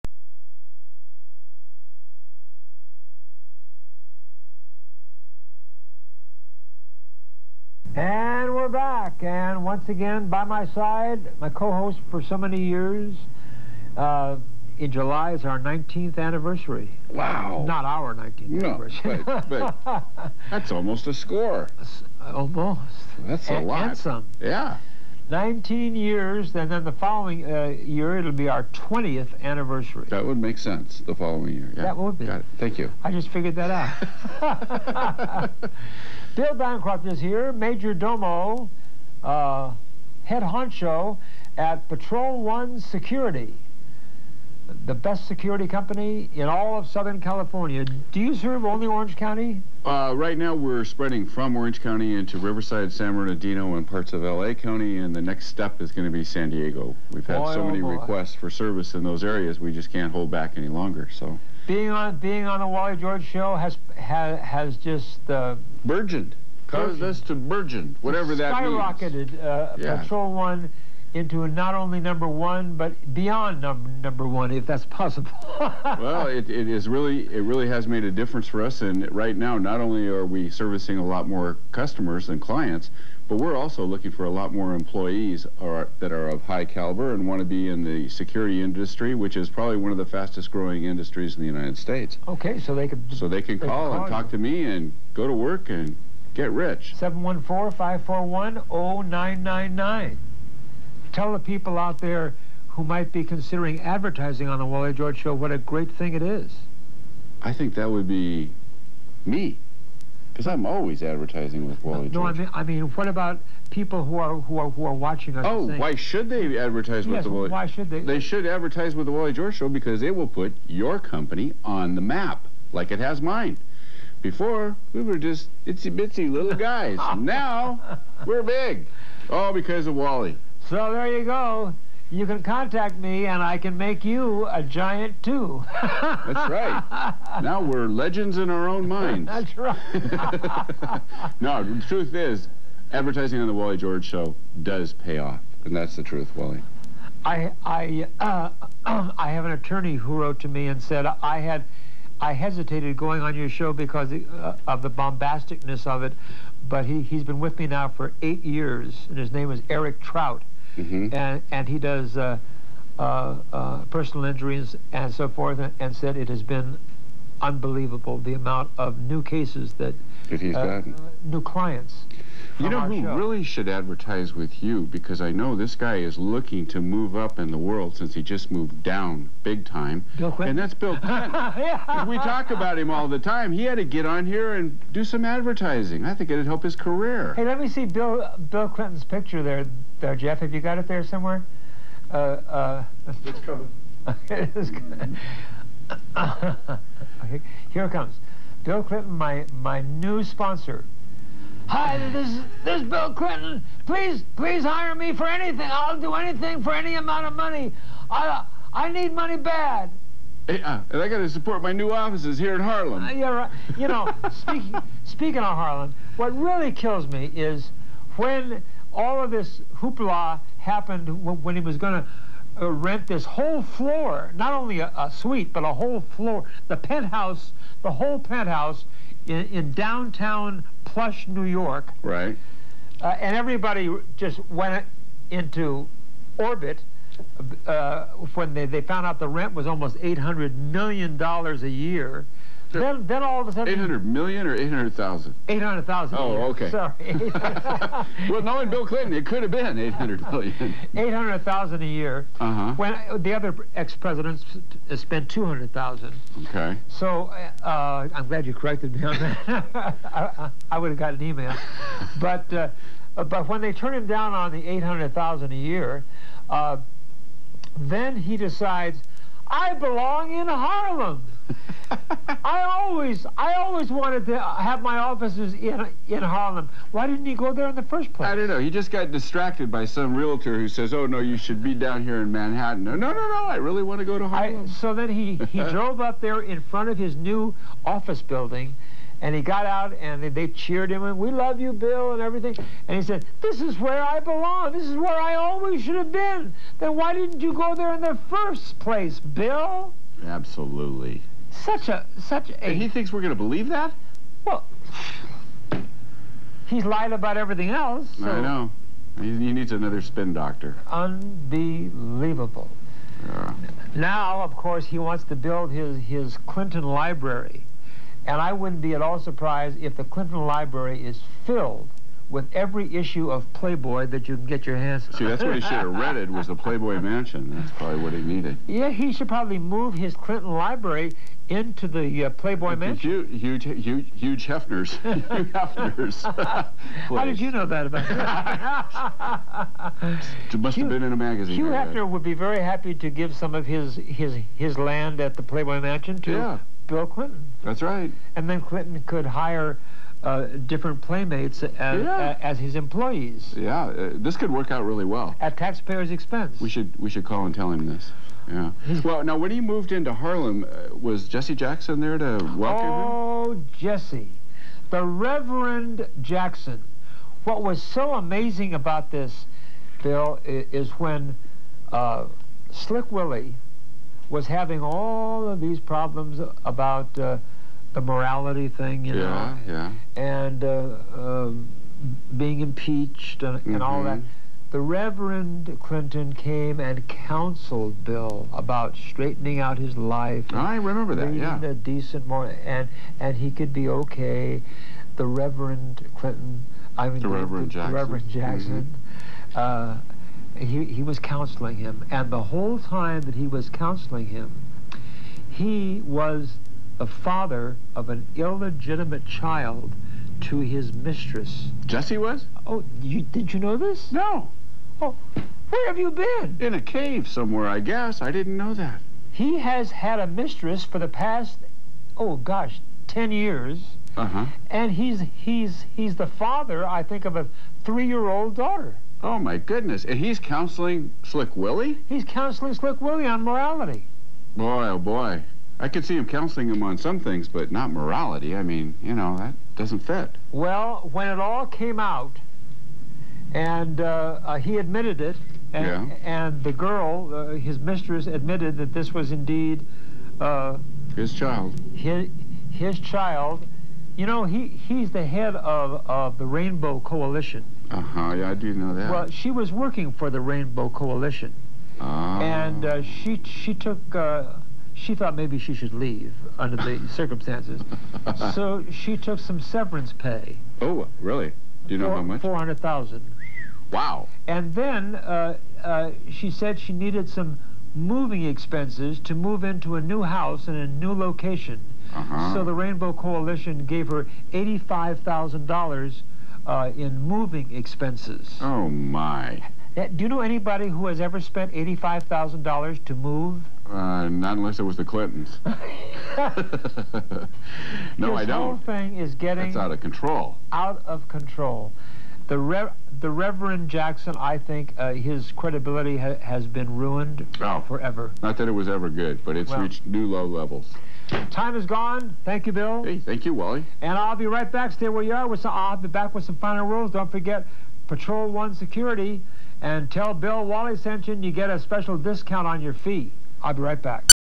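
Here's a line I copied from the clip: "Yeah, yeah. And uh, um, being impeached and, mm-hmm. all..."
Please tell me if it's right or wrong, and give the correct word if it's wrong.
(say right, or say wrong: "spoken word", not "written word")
right.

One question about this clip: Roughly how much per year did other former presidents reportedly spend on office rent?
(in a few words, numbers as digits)
200,000.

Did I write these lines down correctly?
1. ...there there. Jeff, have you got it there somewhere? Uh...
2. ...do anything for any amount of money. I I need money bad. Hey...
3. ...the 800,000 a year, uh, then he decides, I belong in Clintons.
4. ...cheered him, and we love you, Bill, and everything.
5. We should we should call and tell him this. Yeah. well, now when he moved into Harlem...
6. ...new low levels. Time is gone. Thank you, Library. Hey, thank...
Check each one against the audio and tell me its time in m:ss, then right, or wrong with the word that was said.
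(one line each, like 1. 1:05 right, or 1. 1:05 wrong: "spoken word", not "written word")
1. 3:09 right
2. 3:25 right
3. 4:24 wrong: "Harlem", not "Clintons"
4. 4:50 right
5. 5:56 right
6. 8:30 wrong: "Bill", not "Library".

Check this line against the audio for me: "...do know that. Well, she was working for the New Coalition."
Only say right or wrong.
wrong.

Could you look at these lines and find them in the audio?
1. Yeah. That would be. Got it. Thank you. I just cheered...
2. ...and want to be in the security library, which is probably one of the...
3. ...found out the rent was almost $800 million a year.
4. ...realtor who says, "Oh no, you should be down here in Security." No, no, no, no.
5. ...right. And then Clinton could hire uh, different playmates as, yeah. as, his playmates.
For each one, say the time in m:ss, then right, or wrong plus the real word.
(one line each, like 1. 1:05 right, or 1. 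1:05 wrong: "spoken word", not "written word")
1. 0:31 wrong: "figured", not "cheered"
2. 1:27 wrong: "industry", not "library"
3. 3:58 right
4. 4:40 wrong: "Manhattan", not "Security"
5. 5:47 wrong: "employees", not "playmates".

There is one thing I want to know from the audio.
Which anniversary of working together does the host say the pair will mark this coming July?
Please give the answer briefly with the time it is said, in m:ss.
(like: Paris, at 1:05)
19th, at 0:15.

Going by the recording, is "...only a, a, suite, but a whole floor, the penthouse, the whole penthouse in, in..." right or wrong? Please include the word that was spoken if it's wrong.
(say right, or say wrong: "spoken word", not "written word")
right.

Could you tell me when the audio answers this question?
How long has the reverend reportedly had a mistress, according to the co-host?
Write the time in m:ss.
7:03.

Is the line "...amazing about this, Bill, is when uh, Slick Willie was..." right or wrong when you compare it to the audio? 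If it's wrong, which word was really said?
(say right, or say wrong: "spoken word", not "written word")
right.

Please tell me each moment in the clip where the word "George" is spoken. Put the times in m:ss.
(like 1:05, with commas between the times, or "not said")
1:02, 1:44, 1:52, 1:59, 2:23.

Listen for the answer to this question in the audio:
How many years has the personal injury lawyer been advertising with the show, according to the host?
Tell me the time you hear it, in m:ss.
2:38.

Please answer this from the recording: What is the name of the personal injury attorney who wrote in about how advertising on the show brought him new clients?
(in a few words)
Eric Trout.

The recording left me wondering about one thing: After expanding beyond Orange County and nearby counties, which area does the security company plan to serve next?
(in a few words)
San Diego.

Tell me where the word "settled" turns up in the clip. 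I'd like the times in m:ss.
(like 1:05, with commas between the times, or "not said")
not said.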